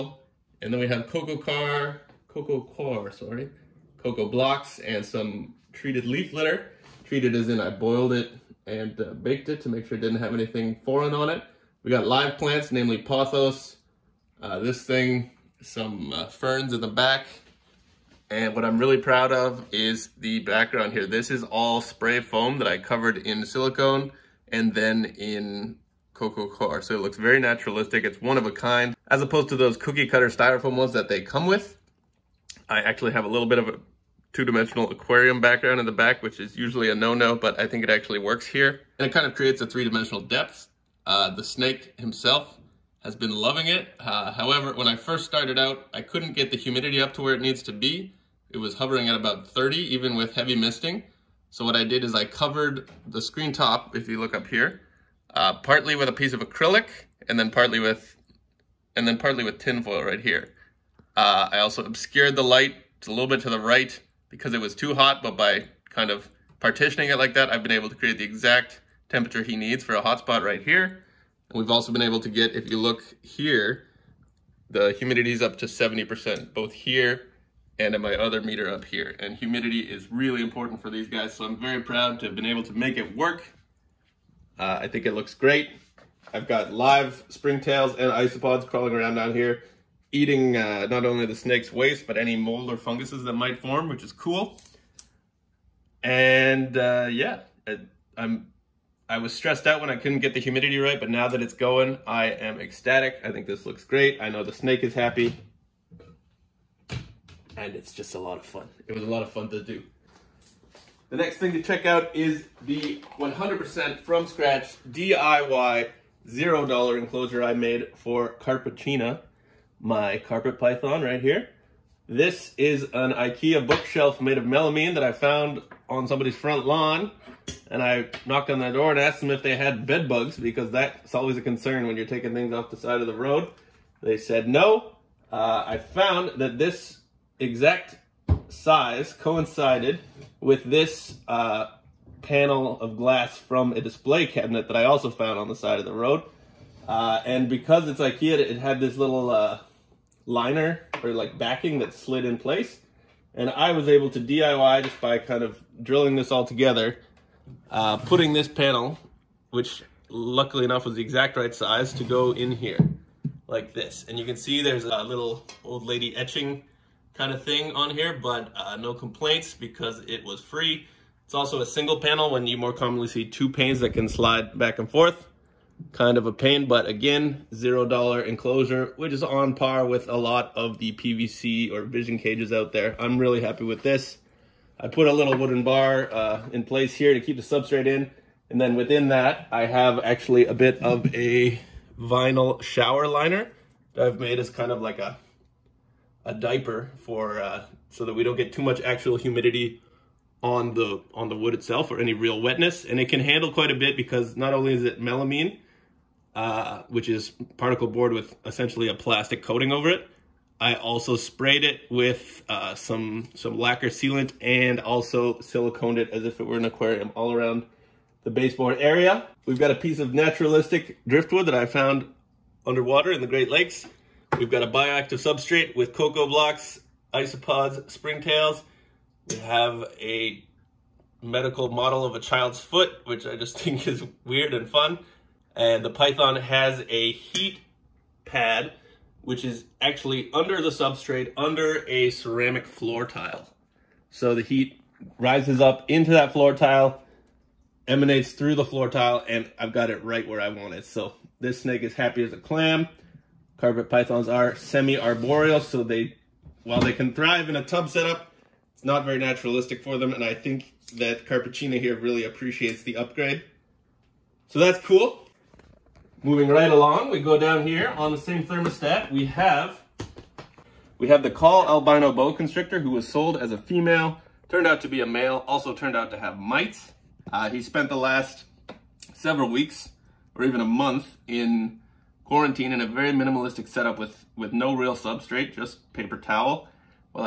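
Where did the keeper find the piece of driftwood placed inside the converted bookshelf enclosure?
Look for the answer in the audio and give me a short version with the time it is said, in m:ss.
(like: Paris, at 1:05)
The Great Lakes, at 3:43.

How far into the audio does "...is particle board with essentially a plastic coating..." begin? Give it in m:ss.
3:27.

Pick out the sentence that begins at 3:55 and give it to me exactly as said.
And the python has a heat pad which is actually under the substrate, under a ceramic floor tile.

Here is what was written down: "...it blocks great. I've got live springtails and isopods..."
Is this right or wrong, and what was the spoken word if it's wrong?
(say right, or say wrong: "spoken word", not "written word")
wrong: "looks", not "blocks".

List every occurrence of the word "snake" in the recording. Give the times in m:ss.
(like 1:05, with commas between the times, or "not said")
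0:41, 1:31, 1:44, 4:11.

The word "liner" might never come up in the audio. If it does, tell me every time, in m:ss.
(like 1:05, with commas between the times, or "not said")
2:30, 3:13.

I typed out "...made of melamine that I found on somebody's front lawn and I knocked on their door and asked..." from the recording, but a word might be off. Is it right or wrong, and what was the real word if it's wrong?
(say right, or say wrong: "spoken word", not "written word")
right.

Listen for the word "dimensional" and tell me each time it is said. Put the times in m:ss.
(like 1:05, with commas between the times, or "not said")
0:34, 0:39.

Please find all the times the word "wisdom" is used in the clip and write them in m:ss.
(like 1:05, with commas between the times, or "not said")
not said.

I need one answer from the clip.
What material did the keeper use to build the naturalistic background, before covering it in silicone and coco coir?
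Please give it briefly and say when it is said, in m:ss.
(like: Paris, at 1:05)
Spray foam, at 0:21.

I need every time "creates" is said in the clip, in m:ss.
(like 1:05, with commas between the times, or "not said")
0:39, 1:07.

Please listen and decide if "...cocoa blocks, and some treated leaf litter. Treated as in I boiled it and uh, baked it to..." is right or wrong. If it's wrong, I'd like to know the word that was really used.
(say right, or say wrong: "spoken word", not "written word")
right.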